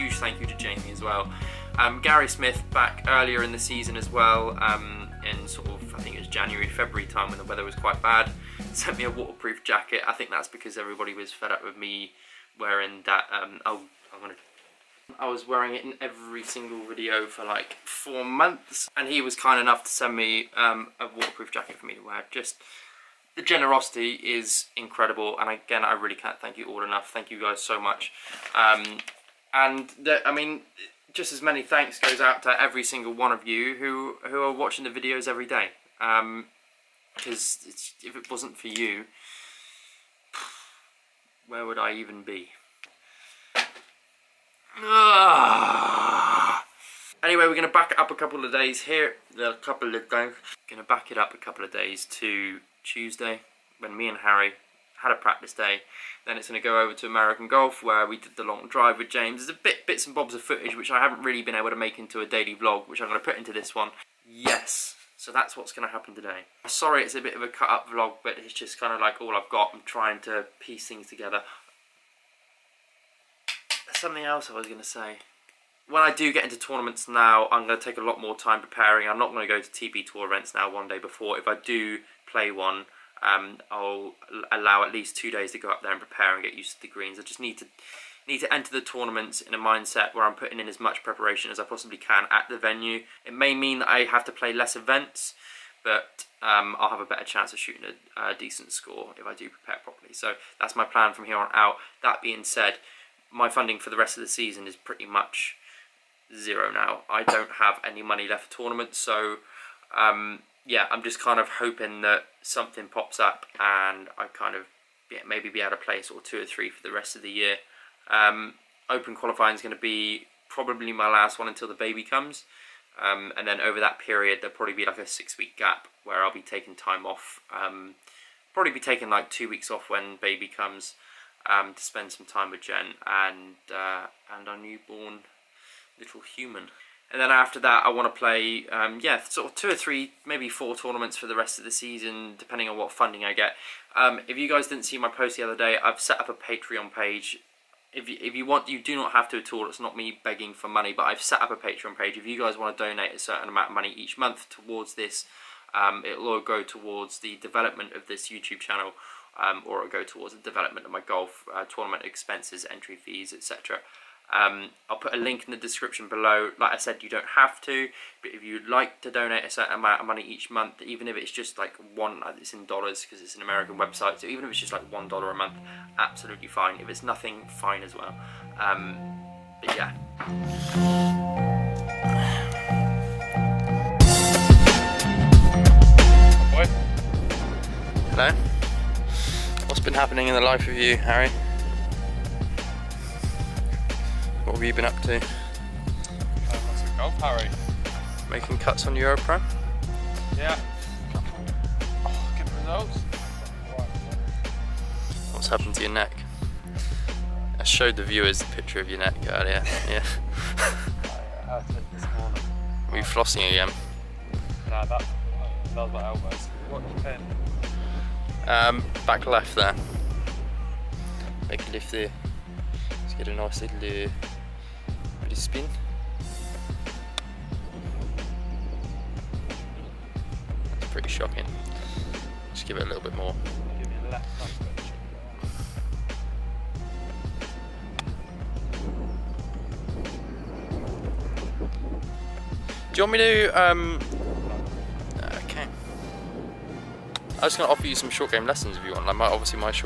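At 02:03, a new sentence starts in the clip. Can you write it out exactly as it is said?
Um, and then over that period, there'll probably be like a six week gap where I'll be taking time off.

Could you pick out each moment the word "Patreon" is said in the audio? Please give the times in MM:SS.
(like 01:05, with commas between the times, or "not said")
02:26, 02:31.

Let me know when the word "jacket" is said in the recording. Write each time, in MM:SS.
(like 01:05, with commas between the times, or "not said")
00:09, 00:21.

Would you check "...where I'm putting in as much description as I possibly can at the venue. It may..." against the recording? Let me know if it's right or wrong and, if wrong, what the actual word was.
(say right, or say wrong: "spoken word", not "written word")
wrong: "preparation", not "description".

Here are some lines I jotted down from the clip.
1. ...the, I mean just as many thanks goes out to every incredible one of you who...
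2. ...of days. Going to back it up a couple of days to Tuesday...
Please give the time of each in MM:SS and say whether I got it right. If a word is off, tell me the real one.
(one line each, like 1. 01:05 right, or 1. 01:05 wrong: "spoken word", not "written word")
1. 00:30 wrong: "single", not "incredible"
2. 00:49 right.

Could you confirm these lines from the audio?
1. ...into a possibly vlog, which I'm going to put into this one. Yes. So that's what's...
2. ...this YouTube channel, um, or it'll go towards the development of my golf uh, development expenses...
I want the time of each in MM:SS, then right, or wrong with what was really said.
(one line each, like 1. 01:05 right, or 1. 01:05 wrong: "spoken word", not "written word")
1. 01:01 wrong: "daily", not "possibly"
2. 02:38 wrong: "tournament", not "development".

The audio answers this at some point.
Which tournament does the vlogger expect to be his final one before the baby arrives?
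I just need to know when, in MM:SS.
01:58.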